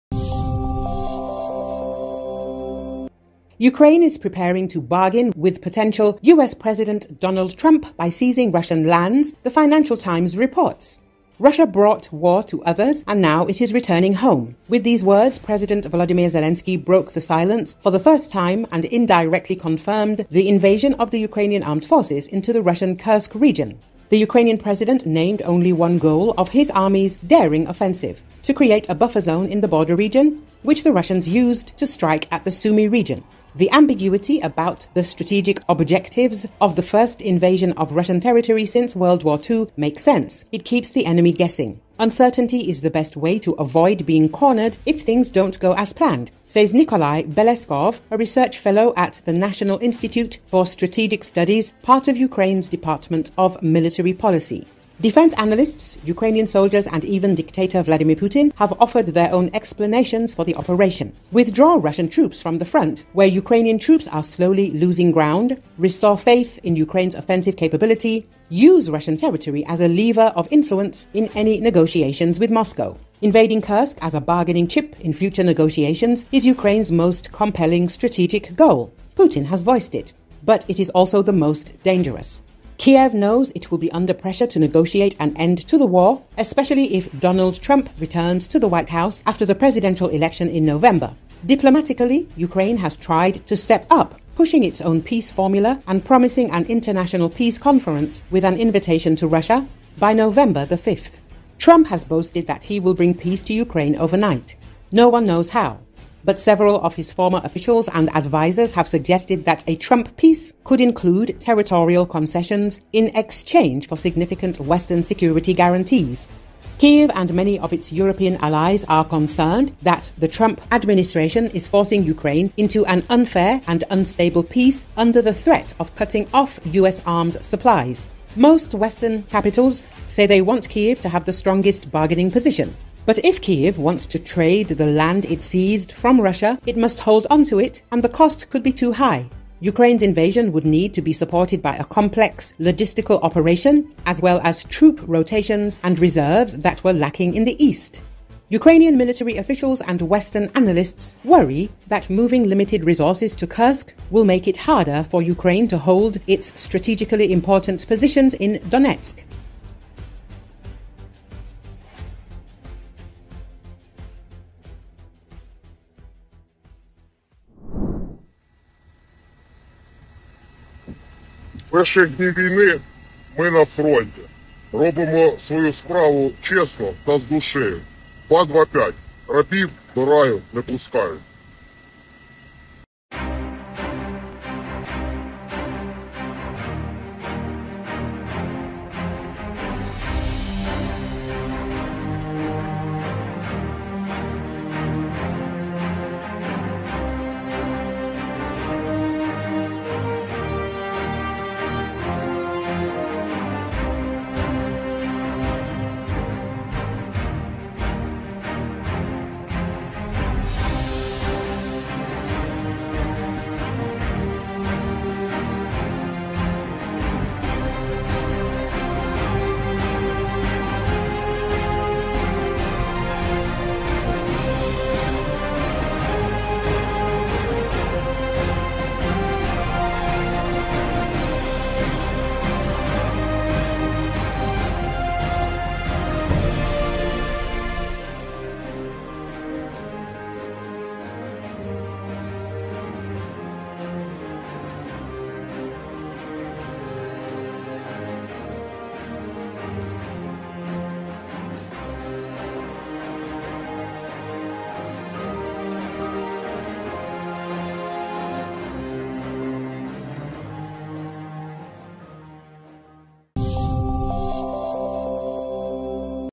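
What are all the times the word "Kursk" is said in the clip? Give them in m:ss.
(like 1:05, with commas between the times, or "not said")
0:22, 1:13, 2:33.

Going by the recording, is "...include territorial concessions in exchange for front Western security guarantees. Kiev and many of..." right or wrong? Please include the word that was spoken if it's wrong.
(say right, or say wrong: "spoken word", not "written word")
wrong: "significant", not "front".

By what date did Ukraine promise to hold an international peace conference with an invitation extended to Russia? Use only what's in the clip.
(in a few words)
November 5.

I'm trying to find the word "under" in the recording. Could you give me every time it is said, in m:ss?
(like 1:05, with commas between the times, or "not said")
1:23, 2:04.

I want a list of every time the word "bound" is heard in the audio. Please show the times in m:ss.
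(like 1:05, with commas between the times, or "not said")
not said.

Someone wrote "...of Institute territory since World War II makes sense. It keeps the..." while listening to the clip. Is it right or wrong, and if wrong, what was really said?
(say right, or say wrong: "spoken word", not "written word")
wrong: "Russian", not "Institute".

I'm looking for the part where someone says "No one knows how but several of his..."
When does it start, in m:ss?
1:44.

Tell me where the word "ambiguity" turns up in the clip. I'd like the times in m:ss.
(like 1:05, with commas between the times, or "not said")
0:33.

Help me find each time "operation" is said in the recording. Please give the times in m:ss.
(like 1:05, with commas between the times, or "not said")
1:00, 2:23.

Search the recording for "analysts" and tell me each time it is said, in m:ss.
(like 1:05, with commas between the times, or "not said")
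0:55, 2:30.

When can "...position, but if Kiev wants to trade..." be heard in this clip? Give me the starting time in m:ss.
2:12.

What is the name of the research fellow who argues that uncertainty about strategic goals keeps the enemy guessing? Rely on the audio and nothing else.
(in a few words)
Nikolai Beleskov.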